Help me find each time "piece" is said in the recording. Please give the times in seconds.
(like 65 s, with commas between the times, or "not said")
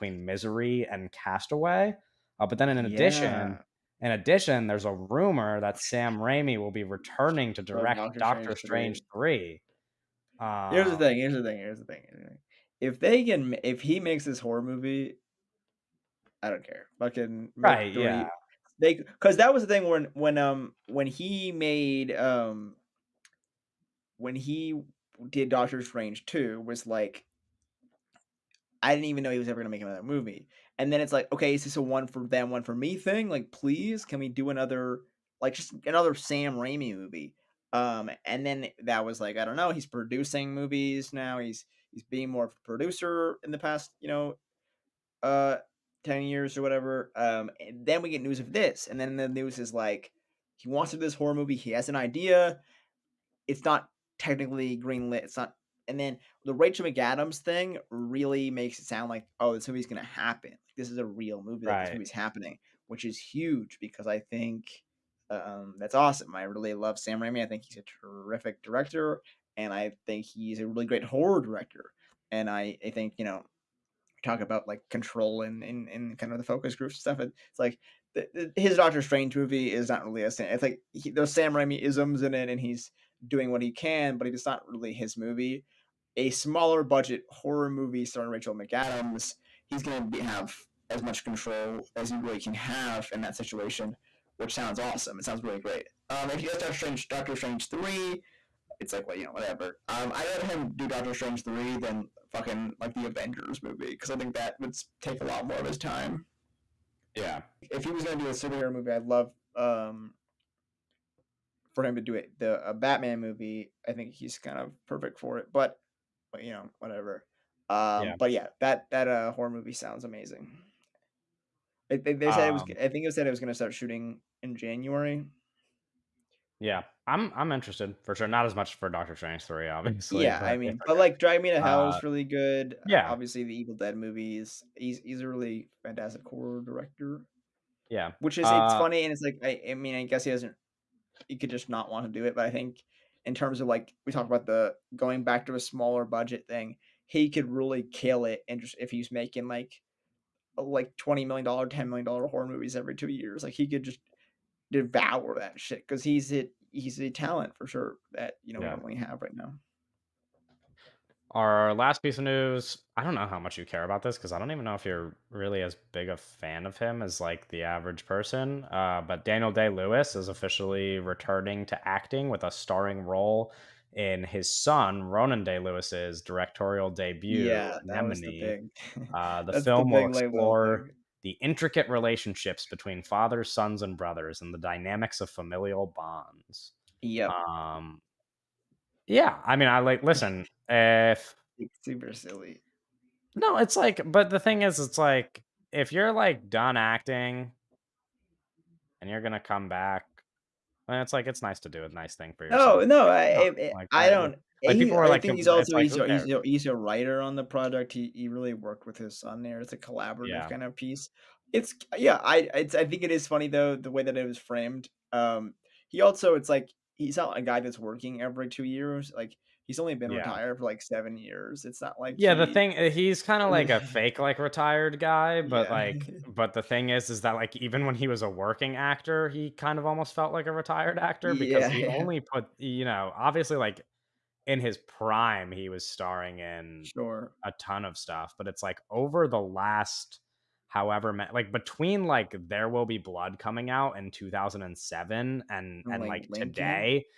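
162 s, 210 s.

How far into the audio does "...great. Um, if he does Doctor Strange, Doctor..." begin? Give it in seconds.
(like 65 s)
95 s.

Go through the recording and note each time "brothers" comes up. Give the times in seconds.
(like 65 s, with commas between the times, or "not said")
183 s.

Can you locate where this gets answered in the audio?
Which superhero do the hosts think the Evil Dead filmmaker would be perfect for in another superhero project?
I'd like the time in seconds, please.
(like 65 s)
112 s.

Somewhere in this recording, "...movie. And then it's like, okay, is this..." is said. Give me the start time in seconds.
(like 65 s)
30 s.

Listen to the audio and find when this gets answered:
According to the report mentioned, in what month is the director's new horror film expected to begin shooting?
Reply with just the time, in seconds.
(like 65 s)
124 s.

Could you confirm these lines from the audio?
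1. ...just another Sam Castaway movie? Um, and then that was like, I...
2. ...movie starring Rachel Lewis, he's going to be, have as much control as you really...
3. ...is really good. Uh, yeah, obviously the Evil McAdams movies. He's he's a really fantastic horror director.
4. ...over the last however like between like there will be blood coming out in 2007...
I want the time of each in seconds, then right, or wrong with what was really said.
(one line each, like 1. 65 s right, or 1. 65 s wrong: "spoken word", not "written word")
1. 35 s wrong: "Raimi", not "Castaway"
2. 87 s wrong: "McAdams", not "Lewis"
3. 131 s wrong: "Dead", not "McAdams"
4. 238 s right.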